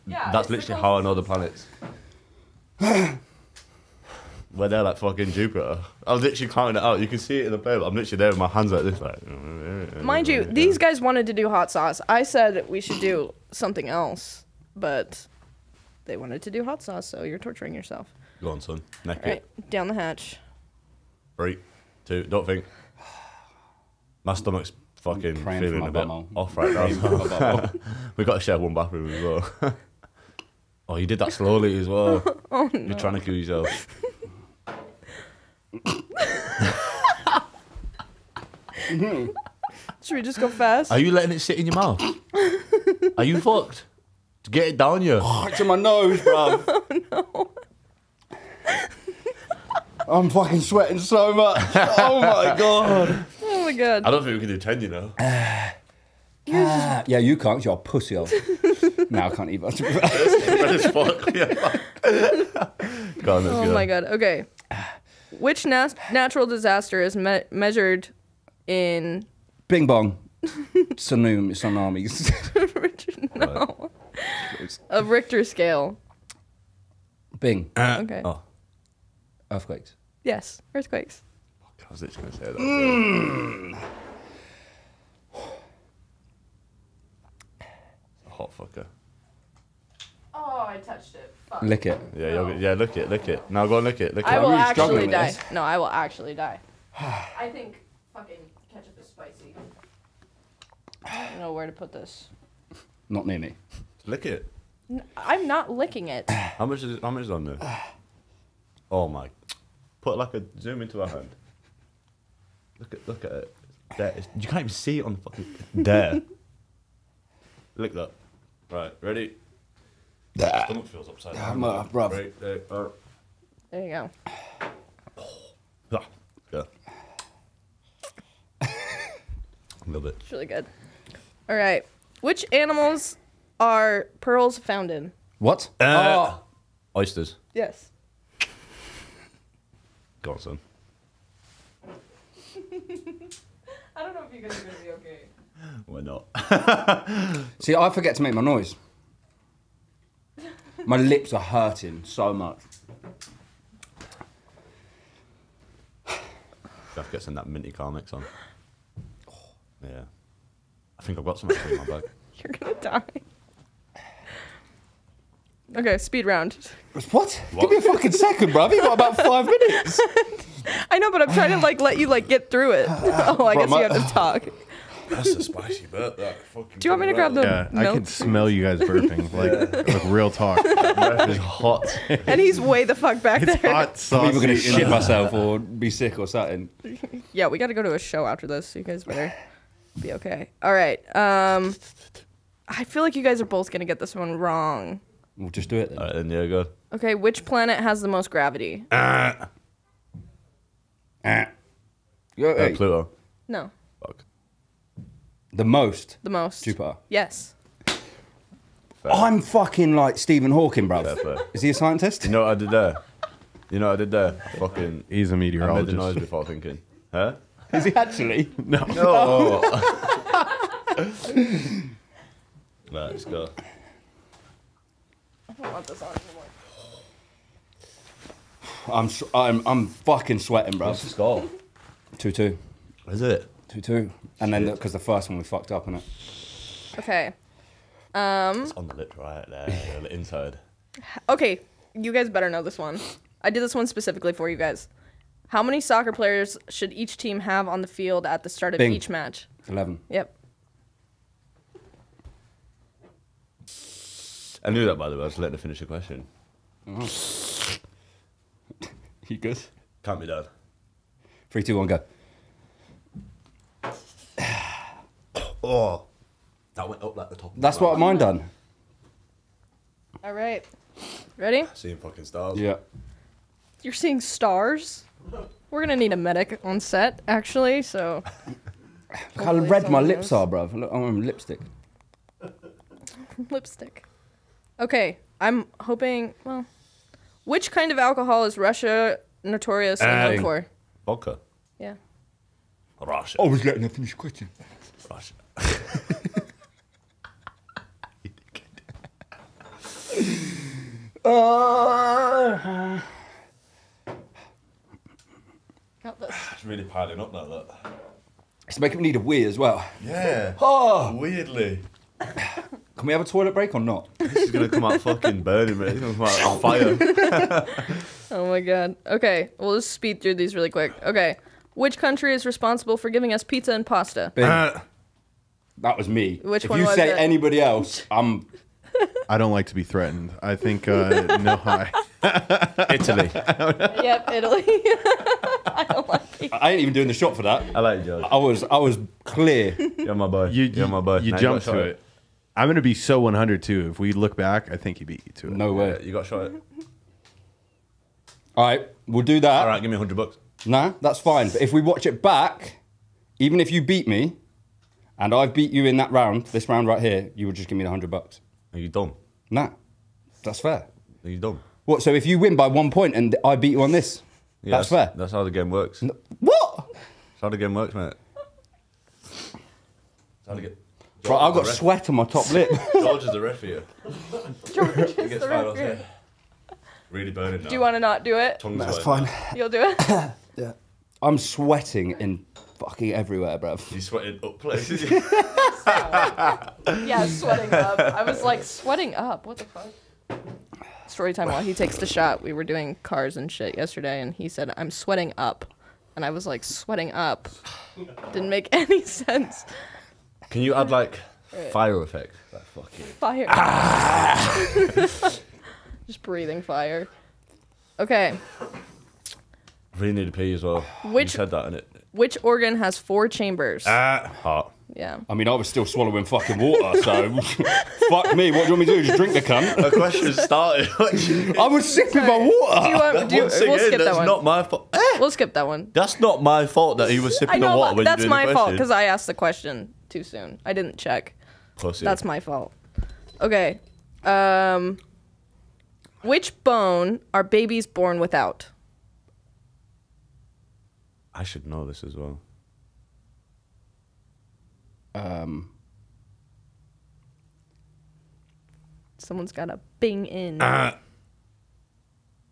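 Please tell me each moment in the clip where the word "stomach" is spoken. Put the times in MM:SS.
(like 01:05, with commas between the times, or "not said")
00:24, 02:00.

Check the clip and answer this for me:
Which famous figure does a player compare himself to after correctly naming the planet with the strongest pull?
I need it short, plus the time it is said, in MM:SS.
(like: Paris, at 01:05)
Stephen Hawking, at 03:30.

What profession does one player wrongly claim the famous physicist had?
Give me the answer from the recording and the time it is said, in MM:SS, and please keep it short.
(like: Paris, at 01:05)
Meteorologist, at 03:35.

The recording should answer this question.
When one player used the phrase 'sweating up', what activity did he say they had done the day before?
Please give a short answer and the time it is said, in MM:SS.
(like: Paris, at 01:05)
Cars, at 06:33.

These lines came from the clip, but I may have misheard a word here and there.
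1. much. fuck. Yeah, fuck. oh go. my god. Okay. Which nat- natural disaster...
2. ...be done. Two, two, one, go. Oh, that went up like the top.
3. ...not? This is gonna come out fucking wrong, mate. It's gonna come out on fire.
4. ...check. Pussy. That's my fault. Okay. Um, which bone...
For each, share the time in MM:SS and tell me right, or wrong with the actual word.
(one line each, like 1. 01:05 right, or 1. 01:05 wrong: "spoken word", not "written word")
1. 00:59 right
2. 04:20 wrong: "Three", not "Two"
3. 05:13 wrong: "burning", not "wrong"
4. 07:10 right.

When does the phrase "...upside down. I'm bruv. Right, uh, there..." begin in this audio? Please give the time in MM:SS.
02:01.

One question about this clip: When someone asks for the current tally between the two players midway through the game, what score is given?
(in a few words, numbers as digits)
2-2.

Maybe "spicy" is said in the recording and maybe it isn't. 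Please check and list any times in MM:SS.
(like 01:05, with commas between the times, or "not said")
01:39, 02:55.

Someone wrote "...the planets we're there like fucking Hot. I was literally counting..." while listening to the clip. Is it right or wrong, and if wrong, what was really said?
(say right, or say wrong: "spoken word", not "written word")
wrong: "Jupiter", not "Hot".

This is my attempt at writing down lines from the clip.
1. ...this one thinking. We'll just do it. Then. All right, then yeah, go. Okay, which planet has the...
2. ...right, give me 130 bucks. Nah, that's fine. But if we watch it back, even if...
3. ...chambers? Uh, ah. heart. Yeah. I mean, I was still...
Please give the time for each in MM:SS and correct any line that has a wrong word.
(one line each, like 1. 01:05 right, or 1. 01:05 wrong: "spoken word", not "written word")
1. 03:13 wrong: "wrong", not "thinking"
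2. 05:49 wrong: "100", not "130"
3. 06:53 right.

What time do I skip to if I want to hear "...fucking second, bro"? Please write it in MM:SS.
02:47.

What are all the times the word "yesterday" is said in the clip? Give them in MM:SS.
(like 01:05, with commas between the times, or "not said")
06:33.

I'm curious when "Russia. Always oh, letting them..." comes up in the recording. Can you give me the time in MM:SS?
04:52.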